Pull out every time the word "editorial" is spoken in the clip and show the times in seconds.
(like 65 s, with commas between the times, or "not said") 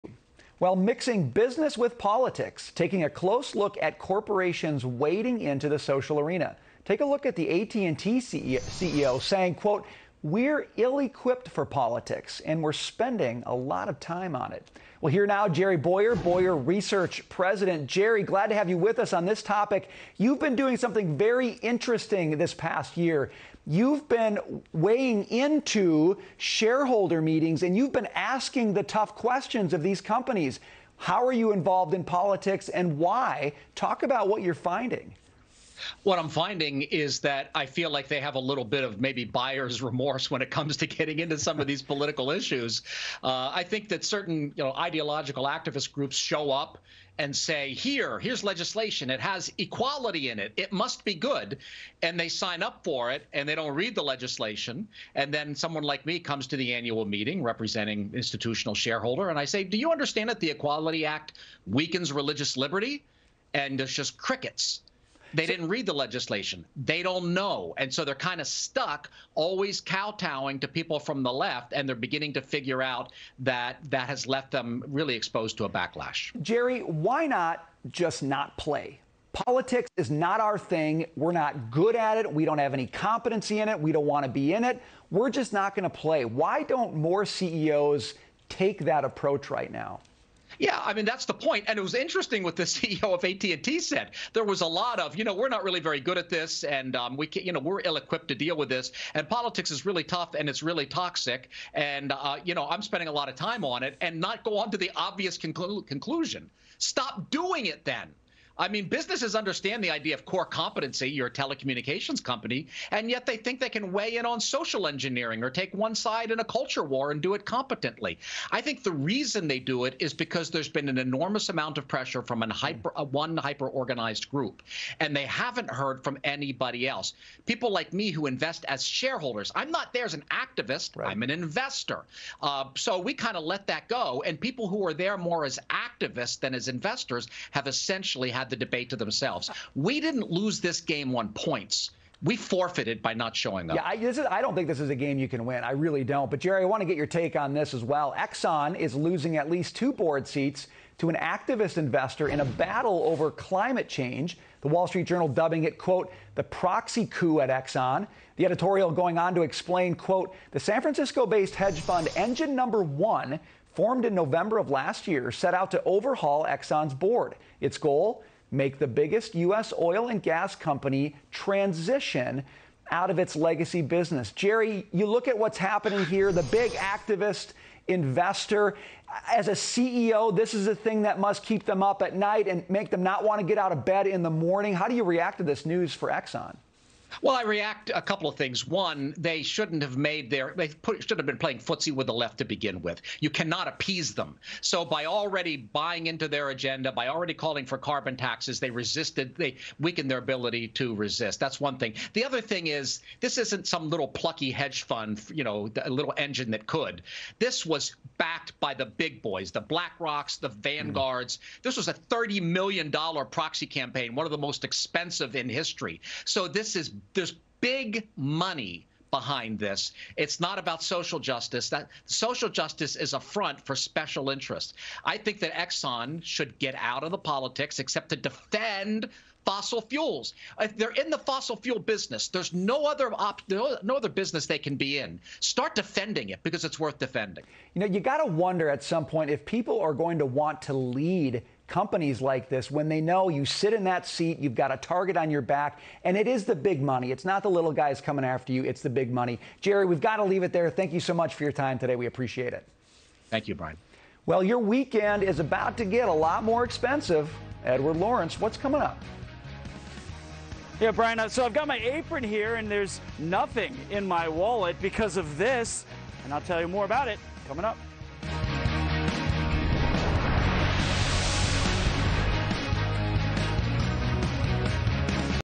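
158 s.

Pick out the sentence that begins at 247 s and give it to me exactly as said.
It's not the little guys coming after you, it's the big money.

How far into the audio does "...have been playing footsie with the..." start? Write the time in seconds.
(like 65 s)
191 s.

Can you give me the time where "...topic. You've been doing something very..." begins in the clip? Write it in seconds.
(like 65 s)
19 s.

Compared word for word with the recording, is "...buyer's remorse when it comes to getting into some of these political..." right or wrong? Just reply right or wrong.
right.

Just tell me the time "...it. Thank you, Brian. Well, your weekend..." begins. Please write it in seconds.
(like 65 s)
252 s.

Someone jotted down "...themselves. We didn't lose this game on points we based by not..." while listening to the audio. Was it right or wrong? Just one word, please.
wrong.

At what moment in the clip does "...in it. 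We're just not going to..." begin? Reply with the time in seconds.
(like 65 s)
84 s.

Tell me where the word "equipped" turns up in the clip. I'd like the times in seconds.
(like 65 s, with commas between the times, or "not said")
10 s, 97 s.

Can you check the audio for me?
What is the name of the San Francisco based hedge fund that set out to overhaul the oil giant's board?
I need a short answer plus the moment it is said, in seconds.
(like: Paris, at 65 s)
Engine Number One, at 162 s.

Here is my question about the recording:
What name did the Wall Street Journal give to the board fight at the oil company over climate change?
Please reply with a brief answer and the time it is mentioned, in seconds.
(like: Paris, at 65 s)
the proxy coup, at 156 s.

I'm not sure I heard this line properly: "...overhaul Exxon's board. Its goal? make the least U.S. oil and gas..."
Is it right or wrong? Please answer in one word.
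wrong.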